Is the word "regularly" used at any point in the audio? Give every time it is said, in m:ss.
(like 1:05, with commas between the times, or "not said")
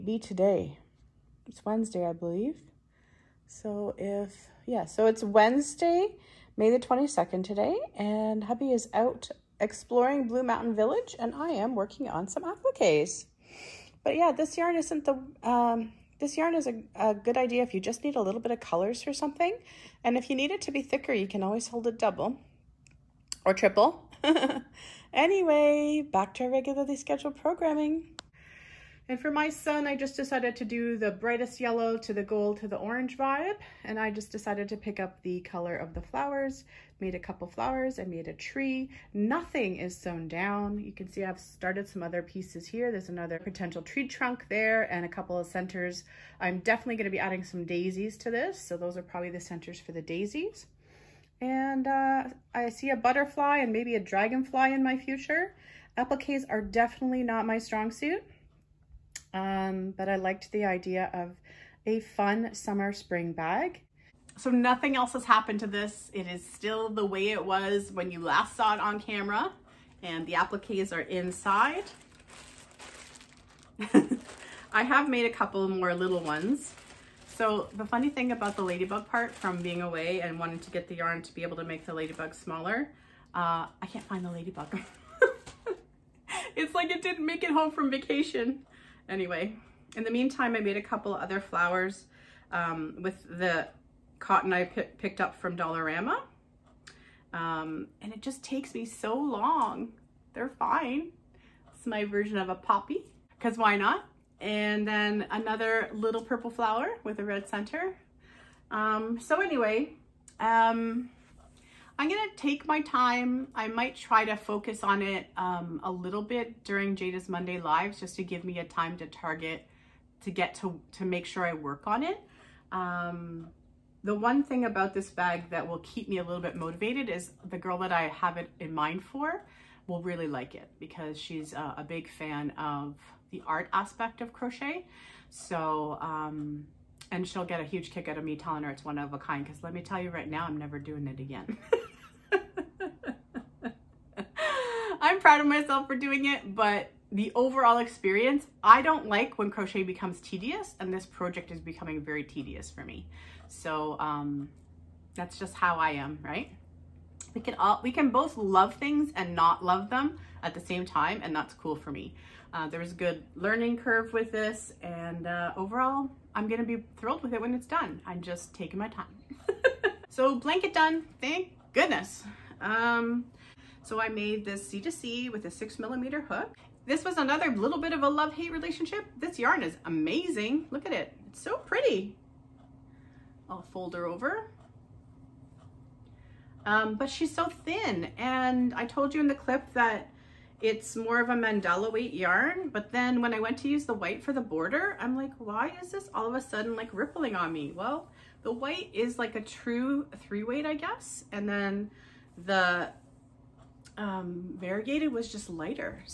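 0:26.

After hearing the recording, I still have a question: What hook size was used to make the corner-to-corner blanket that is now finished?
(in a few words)
6 millimeter.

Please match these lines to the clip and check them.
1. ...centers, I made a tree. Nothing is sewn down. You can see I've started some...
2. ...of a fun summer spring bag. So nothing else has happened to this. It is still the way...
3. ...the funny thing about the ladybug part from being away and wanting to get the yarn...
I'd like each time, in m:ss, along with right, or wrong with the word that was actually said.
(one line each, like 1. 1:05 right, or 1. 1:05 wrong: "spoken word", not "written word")
1. 0:37 wrong: "flowers", not "centers"
2. 1:01 right
3. 1:17 right.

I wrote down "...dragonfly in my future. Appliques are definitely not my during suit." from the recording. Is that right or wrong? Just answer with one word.
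wrong.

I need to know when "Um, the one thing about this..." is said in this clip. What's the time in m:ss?
2:02.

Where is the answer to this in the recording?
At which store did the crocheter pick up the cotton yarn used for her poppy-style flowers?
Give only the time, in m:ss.
1:35.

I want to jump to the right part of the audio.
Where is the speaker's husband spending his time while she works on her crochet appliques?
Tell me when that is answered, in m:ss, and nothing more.
0:10.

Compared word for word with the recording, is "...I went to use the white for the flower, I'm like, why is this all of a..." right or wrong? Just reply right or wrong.
wrong.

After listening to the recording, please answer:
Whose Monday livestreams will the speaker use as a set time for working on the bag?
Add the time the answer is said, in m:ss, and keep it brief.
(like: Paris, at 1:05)
Jayda, at 1:56.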